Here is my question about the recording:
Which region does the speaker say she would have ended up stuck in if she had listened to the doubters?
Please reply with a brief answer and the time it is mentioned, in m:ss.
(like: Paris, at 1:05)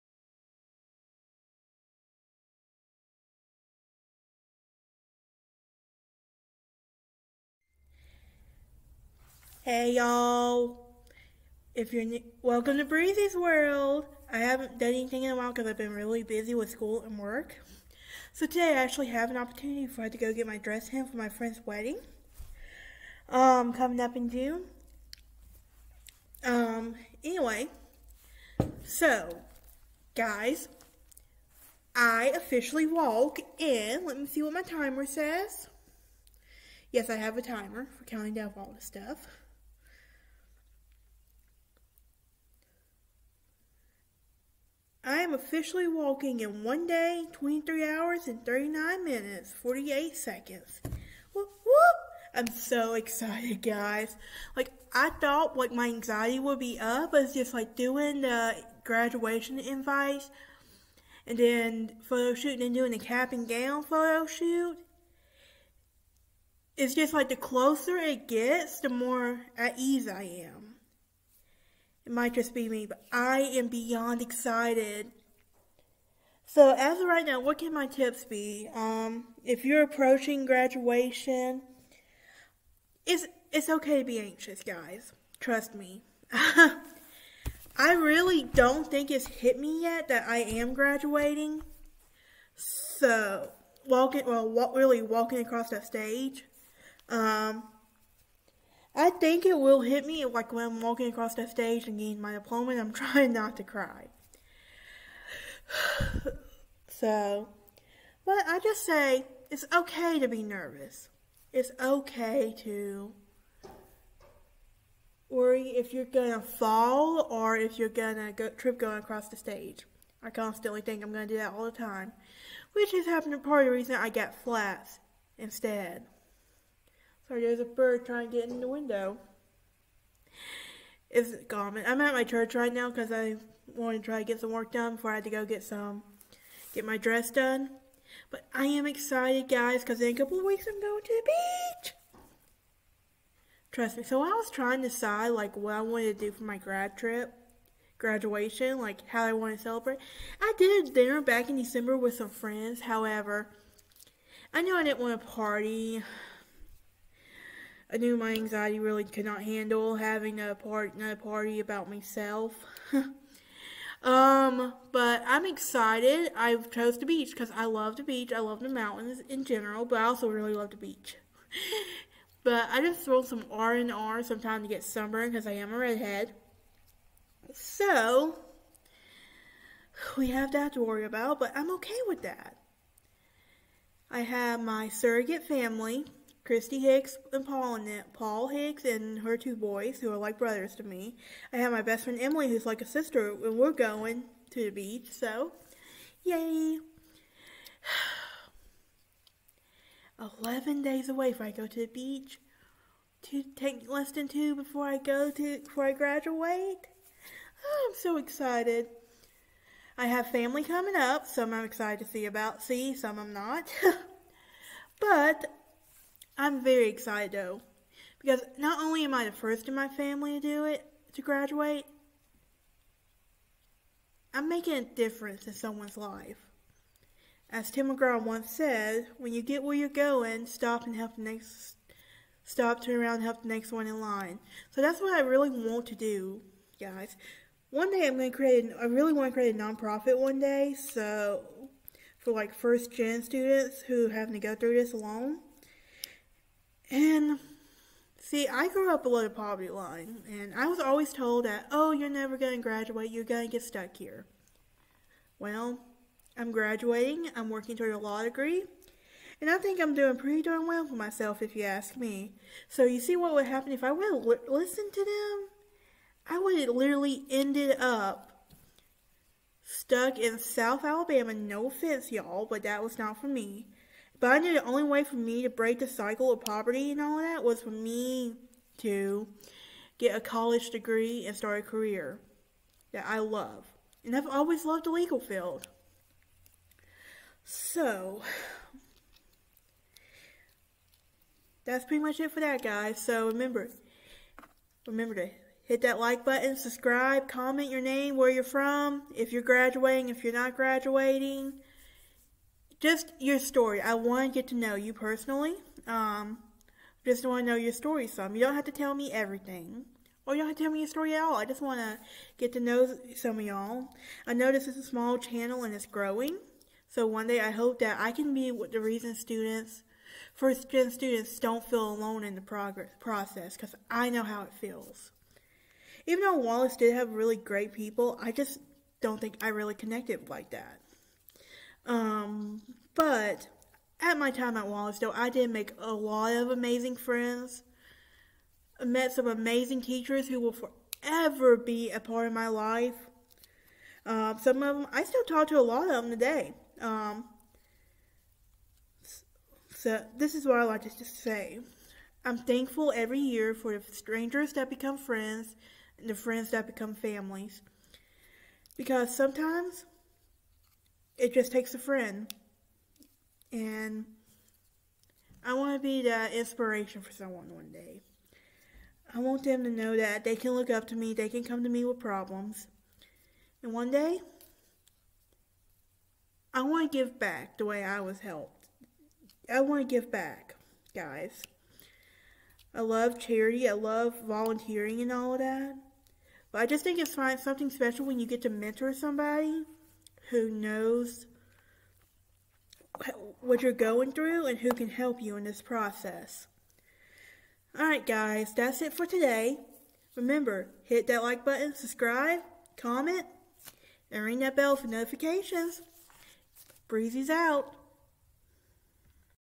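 South Alabama, at 4:30.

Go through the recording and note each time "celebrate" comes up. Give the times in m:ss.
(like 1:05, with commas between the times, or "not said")
2:29.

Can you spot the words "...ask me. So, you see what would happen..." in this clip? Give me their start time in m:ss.
4:21.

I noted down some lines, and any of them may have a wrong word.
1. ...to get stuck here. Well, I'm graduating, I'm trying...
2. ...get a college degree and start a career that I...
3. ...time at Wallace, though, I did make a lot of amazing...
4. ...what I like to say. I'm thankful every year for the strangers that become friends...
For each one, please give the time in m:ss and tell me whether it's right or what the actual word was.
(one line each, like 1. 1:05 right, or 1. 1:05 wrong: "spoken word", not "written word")
1. 4:13 wrong: "working", not "trying"
2. 4:39 right
3. 5:34 right
4. 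5:50 right.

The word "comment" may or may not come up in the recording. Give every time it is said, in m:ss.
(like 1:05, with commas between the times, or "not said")
4:57, 6:42.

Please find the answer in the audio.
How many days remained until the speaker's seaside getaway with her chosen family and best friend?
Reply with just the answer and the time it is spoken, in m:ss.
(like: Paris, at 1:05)
11, at 3:20.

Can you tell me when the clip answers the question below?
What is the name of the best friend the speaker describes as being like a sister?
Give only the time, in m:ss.
3:12.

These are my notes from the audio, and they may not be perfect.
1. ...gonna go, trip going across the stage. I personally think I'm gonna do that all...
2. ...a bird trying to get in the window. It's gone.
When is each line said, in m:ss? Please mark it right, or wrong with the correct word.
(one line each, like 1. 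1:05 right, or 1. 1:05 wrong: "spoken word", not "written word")
1. 1:57 wrong: "constantly", not "personally"
2. 2:07 right.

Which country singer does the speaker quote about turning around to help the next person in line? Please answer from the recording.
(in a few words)
Tim McGraw.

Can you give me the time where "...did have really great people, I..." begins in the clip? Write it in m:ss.
5:26.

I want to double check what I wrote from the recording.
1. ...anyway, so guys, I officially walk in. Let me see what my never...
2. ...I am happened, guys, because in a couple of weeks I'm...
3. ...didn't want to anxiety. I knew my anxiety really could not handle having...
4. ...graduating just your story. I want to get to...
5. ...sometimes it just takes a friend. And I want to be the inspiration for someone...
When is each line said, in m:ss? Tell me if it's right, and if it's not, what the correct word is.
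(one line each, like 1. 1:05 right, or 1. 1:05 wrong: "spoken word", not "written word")
1. 0:27 wrong: "timer", not "never"
2. 2:18 wrong: "excited", not "happened"
3. 2:34 wrong: "party", not "anxiety"
4. 5:00 right
5. 5:59 right.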